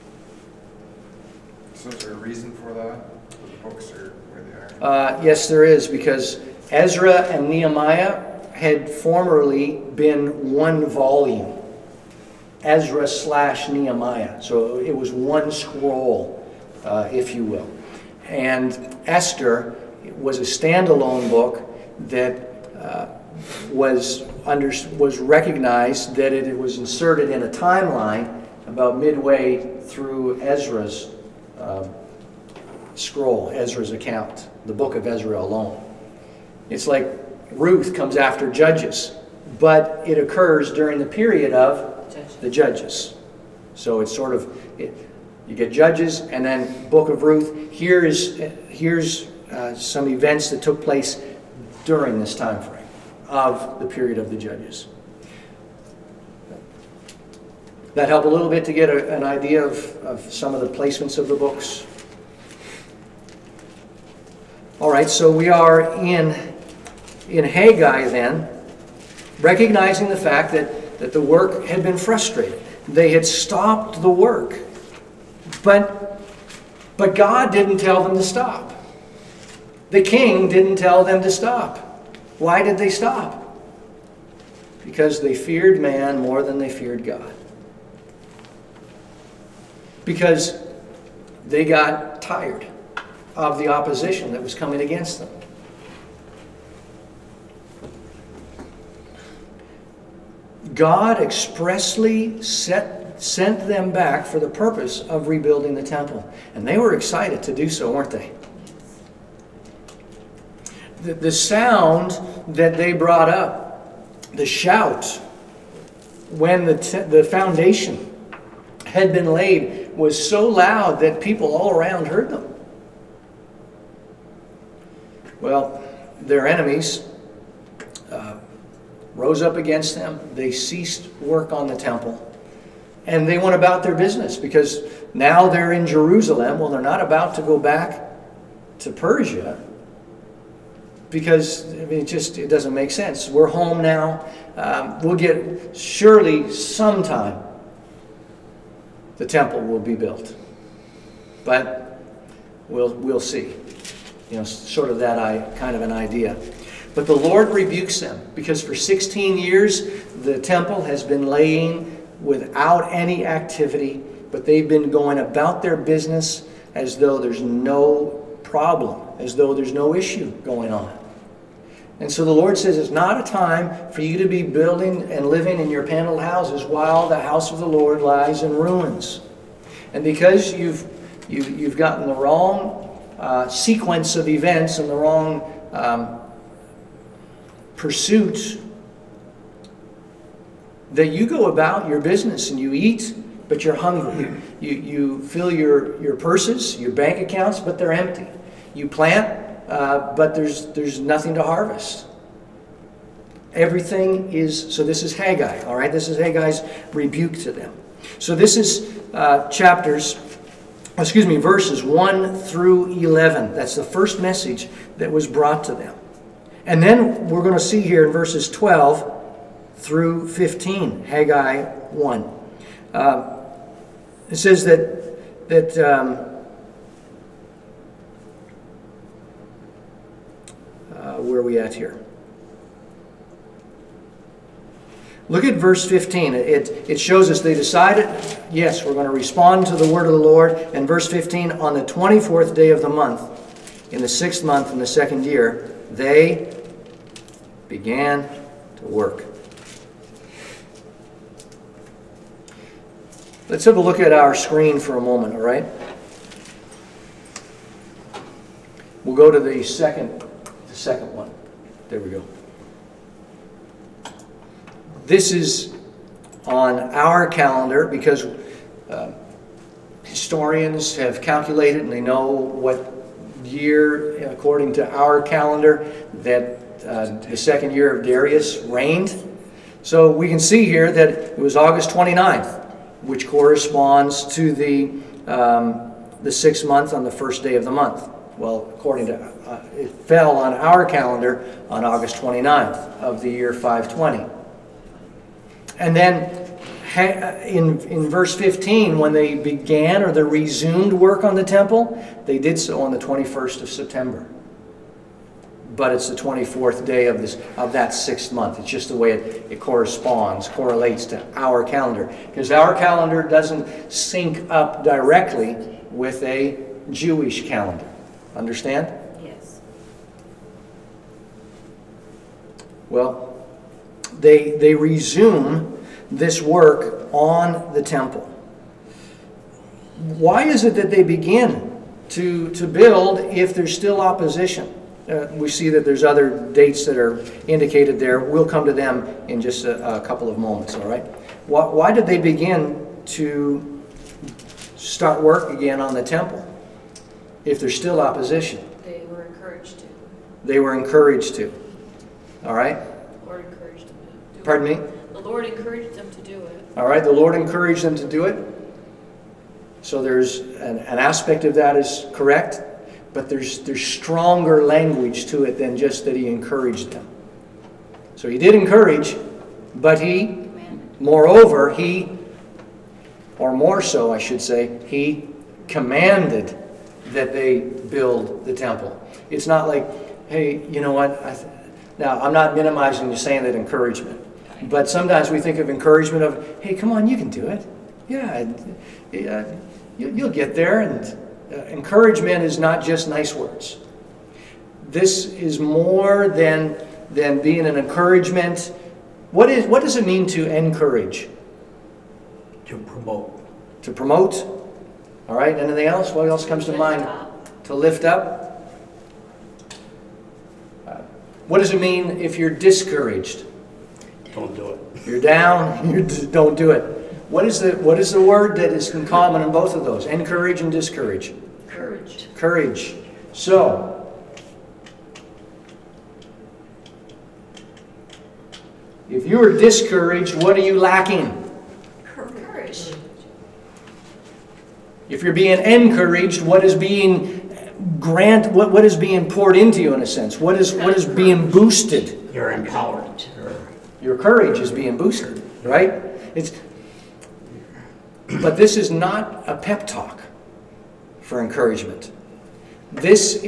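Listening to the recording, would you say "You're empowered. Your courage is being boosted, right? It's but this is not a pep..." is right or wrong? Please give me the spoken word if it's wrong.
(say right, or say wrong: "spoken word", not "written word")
right.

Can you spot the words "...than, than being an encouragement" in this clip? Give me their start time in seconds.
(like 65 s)
396 s.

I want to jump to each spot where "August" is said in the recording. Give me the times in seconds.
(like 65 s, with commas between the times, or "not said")
281 s, 291 s.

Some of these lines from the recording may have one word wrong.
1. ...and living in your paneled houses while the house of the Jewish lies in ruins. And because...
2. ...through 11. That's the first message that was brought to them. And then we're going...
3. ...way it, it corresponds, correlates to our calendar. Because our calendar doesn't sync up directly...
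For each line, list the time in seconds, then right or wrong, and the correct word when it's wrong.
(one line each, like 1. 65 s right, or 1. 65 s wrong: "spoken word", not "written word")
1. 175 s wrong: "Lord", not "Jewish"
2. 212 s right
3. 308 s right.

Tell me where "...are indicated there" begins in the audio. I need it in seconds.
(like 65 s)
336 s.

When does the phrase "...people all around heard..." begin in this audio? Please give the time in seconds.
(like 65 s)
121 s.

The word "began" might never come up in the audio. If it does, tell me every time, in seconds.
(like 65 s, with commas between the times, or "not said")
247 s, 299 s.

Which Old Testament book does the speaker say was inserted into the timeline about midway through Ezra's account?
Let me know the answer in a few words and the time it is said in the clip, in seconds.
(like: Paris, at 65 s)
Esther, at 19 s.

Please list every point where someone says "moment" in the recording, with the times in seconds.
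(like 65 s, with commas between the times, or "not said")
255 s, 340 s.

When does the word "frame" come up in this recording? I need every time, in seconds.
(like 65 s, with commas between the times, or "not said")
52 s.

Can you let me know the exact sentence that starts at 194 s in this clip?
You, you fill your, your purses, your bank accounts, but they're empty.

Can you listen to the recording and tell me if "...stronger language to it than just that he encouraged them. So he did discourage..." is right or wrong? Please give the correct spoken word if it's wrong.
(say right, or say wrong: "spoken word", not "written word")
wrong: "encourage", not "discourage".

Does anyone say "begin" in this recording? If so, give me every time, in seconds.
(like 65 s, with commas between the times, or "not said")
331 s, 342 s.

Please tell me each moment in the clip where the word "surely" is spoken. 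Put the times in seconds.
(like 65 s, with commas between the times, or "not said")
145 s.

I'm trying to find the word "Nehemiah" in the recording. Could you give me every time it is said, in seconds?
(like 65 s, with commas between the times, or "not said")
7 s, 13 s.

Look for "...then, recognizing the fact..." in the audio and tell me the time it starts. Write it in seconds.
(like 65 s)
68 s.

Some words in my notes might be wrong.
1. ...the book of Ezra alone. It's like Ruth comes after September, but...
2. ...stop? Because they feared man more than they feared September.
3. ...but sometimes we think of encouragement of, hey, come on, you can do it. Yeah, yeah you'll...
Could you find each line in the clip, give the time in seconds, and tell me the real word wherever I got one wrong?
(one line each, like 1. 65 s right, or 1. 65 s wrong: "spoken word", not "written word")
1. 34 s wrong: "Judges", not "September"
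2. 82 s wrong: "God", not "September"
3. 384 s right.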